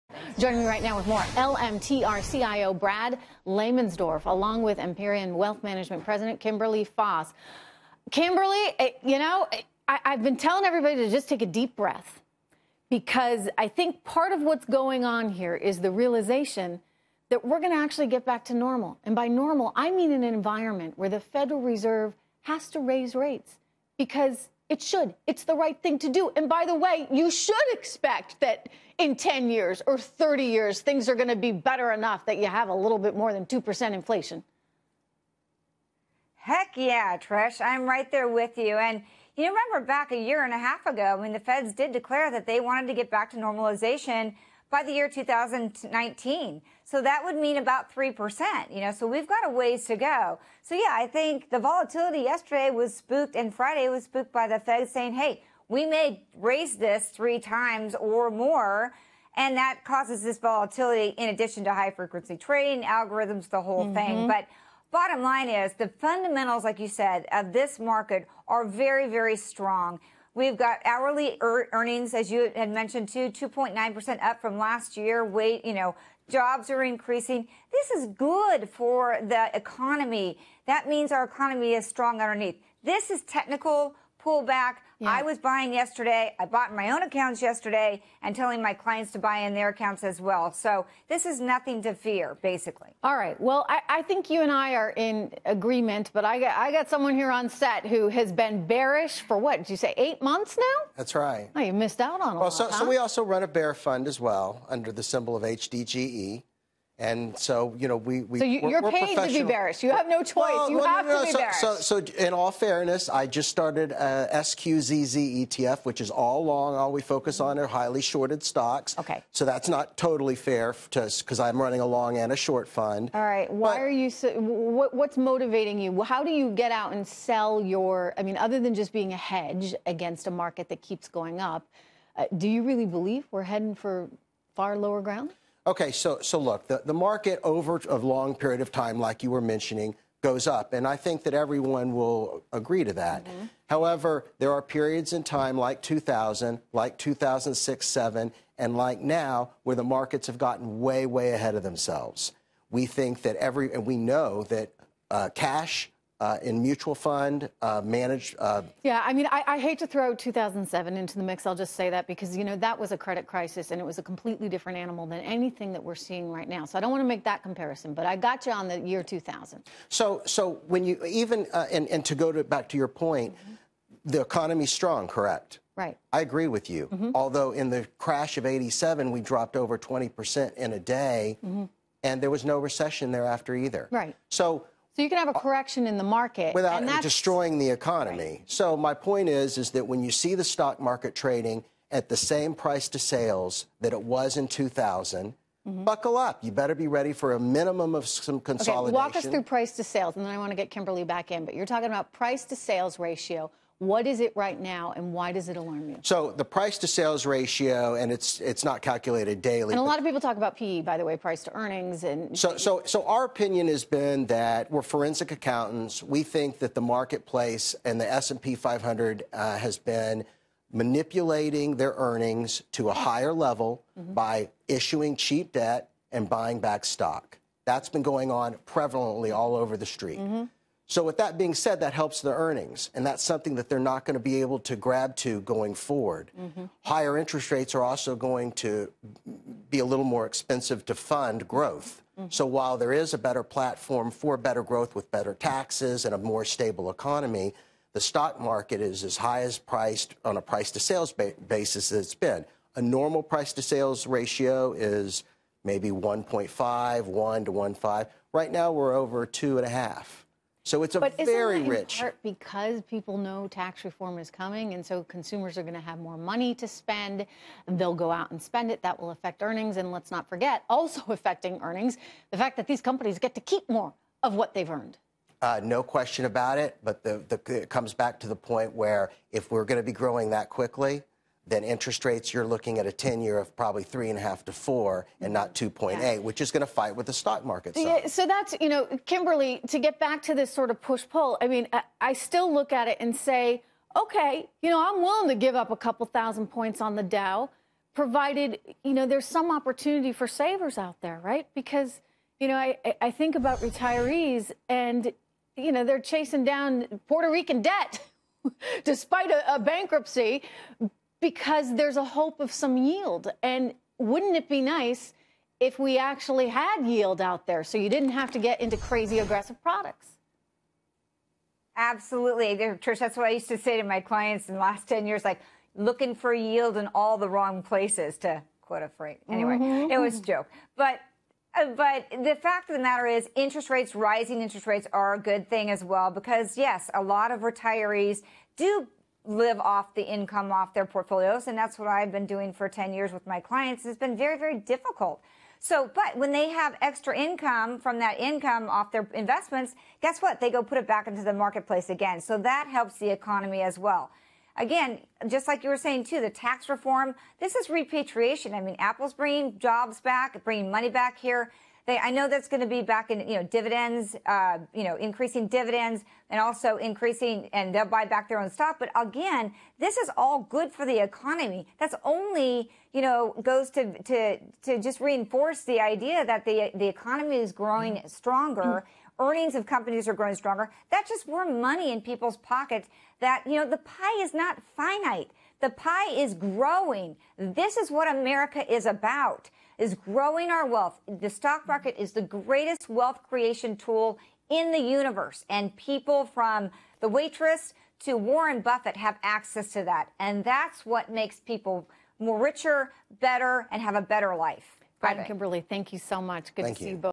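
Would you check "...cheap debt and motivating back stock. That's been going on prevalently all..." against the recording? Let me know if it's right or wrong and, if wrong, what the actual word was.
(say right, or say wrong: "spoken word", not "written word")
wrong: "buying", not "motivating".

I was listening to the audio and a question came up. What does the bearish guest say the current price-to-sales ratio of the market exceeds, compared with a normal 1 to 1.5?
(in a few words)
2.5.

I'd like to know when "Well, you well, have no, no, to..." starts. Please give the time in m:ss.
1:50.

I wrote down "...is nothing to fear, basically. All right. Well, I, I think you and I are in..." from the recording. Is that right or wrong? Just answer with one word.
right.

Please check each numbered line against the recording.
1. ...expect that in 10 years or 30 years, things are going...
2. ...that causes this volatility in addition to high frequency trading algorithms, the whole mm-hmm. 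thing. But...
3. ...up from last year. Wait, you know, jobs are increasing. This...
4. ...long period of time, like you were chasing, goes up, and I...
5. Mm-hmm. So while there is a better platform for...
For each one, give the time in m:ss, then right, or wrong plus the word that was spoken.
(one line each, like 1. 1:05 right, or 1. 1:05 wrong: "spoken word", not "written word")
1. 0:27 right
2. 0:59 right
3. 1:14 right
4. 2:17 wrong: "mentioning", not "chasing"
5. 4:02 right.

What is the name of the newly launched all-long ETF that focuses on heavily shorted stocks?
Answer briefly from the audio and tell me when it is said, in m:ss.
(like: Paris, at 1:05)
SQZZ, at 1:54.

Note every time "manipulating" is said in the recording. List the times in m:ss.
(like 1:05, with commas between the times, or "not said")
3:40.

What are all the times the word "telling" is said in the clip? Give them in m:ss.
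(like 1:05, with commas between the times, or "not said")
0:10, 1:28.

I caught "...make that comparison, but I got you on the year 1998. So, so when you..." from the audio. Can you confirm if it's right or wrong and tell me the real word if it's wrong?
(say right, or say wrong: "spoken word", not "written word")
wrong: "2000", not "1998".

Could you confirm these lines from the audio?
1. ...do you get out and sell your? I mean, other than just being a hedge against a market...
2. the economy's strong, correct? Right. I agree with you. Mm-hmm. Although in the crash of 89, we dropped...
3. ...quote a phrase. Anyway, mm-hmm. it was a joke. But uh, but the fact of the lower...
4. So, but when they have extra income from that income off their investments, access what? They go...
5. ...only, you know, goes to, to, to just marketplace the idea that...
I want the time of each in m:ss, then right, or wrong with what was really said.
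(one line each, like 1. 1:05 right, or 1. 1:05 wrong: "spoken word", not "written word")
1. 2:06 right
2. 2:54 wrong: "87", not "89"
3. 5:28 wrong: "matter", not "lower"
4. 5:45 wrong: "guess", not "access"
5. 6:12 wrong: "reinforce", not "marketplace".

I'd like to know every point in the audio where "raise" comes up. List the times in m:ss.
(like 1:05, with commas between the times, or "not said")
0:22, 0:56.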